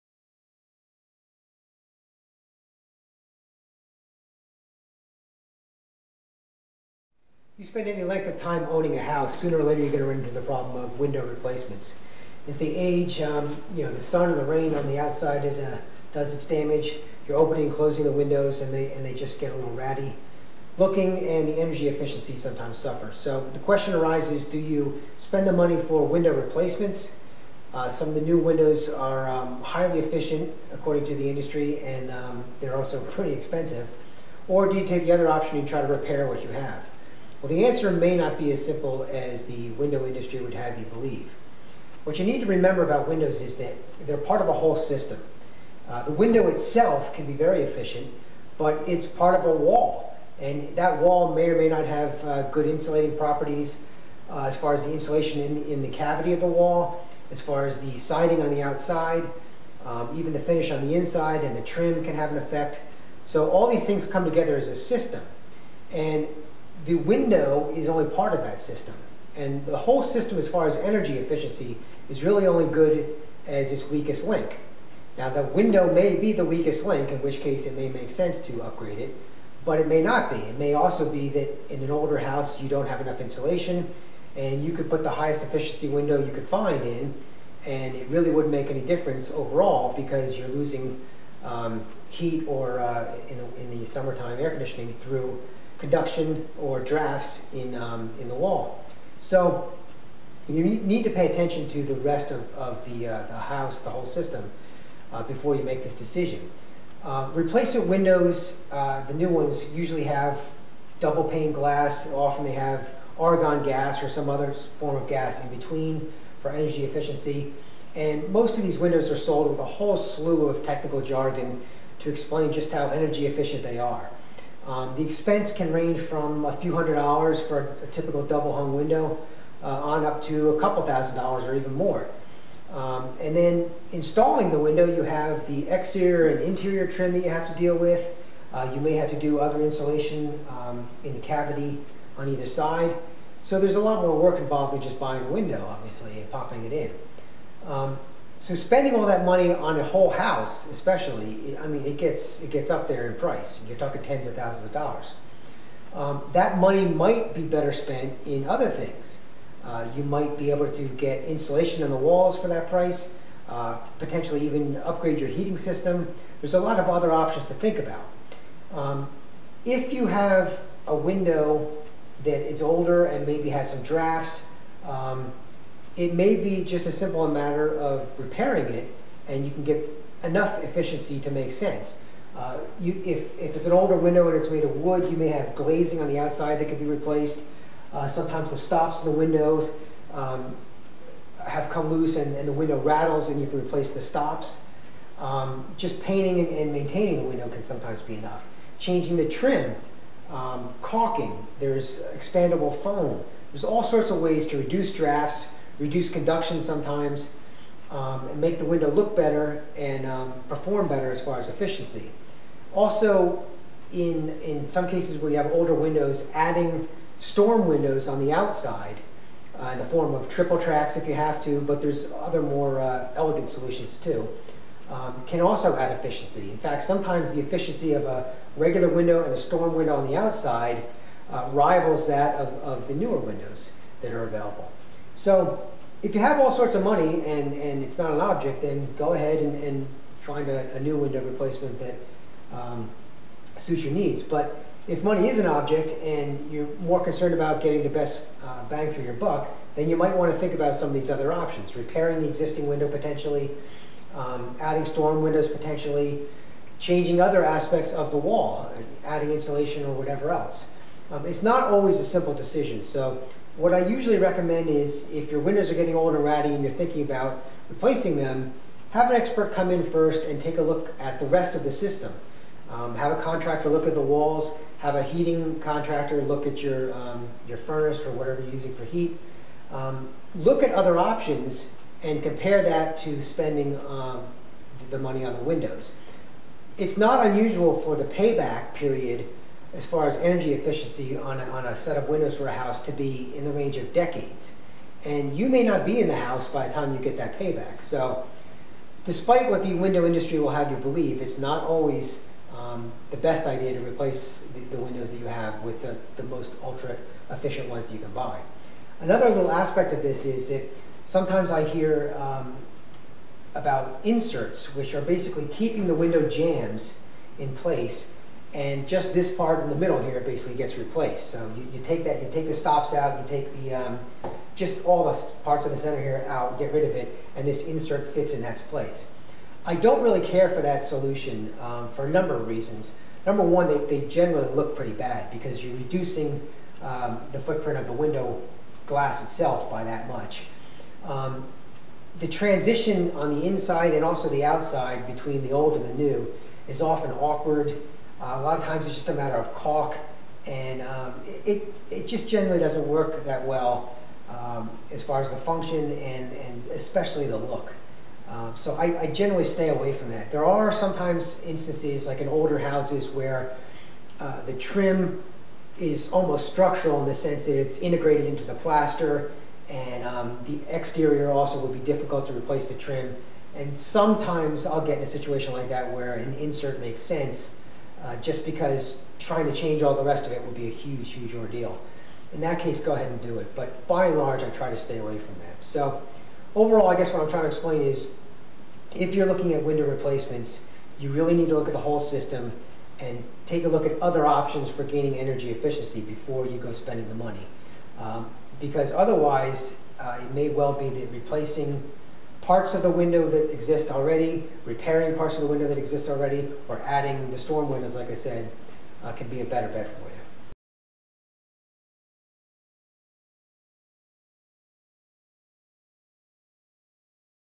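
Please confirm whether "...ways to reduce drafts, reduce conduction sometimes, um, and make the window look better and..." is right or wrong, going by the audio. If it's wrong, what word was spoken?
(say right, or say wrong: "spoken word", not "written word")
right.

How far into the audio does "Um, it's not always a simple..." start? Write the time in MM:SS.
04:21.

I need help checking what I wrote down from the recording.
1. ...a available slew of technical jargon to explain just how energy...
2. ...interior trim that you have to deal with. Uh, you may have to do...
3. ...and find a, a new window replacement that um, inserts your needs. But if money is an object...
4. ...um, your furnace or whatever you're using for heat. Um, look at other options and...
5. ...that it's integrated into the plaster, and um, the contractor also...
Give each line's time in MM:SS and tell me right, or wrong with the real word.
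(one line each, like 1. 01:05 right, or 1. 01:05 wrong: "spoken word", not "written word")
1. 01:59 wrong: "whole", not "available"
2. 02:16 right
3. 03:59 wrong: "suits", not "inserts"
4. 04:36 right
5. 06:07 wrong: "exterior", not "contractor".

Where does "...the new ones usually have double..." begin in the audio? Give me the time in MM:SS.
01:49.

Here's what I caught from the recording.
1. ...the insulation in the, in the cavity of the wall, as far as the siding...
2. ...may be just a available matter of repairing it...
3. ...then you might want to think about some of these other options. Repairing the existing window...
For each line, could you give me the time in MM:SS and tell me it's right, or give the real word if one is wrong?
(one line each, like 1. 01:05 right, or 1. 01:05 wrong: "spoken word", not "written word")
1. 00:54 right
2. 02:56 wrong: "simple", not "available"
3. 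04:09 right.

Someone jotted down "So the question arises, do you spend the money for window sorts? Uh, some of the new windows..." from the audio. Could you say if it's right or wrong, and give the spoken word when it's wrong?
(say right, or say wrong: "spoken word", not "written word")
wrong: "replacements", not "sorts".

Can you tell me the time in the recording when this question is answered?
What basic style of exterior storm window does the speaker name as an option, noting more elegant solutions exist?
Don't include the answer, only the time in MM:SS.
03:40.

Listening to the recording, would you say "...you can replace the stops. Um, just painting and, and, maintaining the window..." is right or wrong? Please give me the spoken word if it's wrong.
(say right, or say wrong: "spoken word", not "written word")
right.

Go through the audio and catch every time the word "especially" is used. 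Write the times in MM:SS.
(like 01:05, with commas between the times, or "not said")
02:30, 05:56.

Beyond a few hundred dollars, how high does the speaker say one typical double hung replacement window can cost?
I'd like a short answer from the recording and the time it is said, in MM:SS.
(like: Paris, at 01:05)
a couple thousand dollars, at 02:10.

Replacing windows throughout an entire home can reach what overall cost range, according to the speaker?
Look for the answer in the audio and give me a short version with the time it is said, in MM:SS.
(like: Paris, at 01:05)
tens of thousands of dollars, at 02:34.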